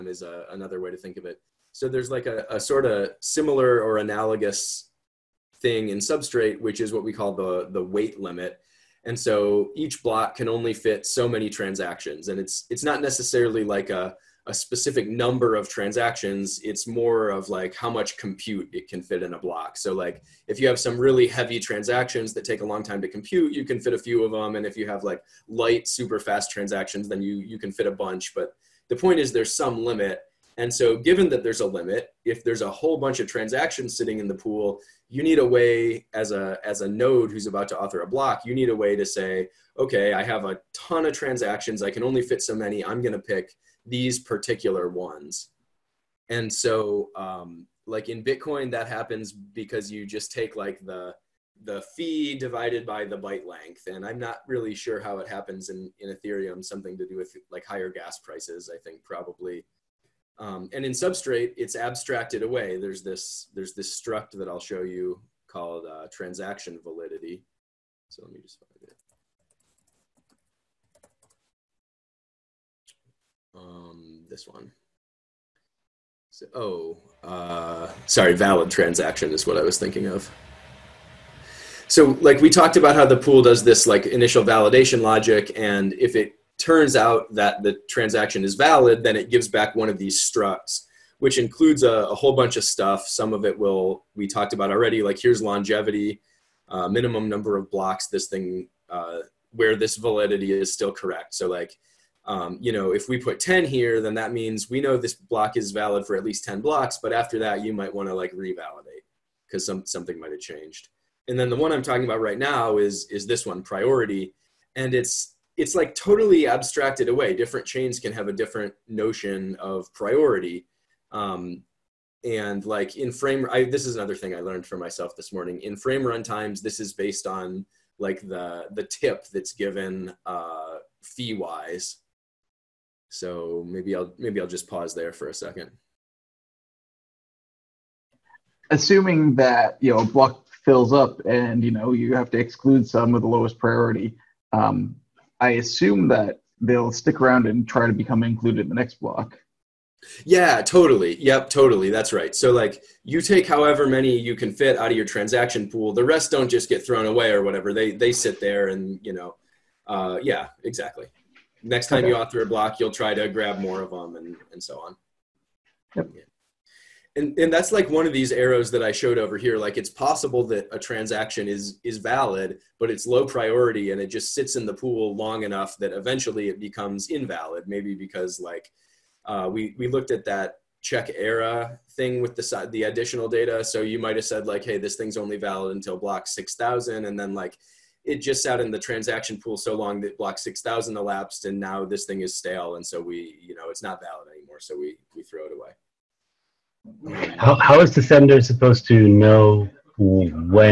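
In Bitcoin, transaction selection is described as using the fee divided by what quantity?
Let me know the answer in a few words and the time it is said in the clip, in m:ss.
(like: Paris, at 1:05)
byte length, at 0:53.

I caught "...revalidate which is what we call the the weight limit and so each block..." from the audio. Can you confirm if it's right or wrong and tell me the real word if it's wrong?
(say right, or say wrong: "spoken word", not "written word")
wrong: "substrate", not "revalidate".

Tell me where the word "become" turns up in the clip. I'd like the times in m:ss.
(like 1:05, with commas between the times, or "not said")
2:27, 2:56.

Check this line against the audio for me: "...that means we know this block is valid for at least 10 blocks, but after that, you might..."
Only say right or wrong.
right.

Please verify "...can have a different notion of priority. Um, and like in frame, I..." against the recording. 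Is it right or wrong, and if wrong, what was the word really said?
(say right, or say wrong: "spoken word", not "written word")
right.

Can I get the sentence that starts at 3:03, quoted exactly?
So you might've said like, hey, this thing's only valid until block 6,000.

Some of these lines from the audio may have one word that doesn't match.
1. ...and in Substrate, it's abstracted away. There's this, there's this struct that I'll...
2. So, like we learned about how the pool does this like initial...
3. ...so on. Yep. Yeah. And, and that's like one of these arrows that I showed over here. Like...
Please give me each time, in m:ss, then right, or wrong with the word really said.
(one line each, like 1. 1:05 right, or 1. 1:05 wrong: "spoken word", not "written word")
1. 1:00 right
2. 1:21 wrong: "talked", not "learned"
3. 2:44 right.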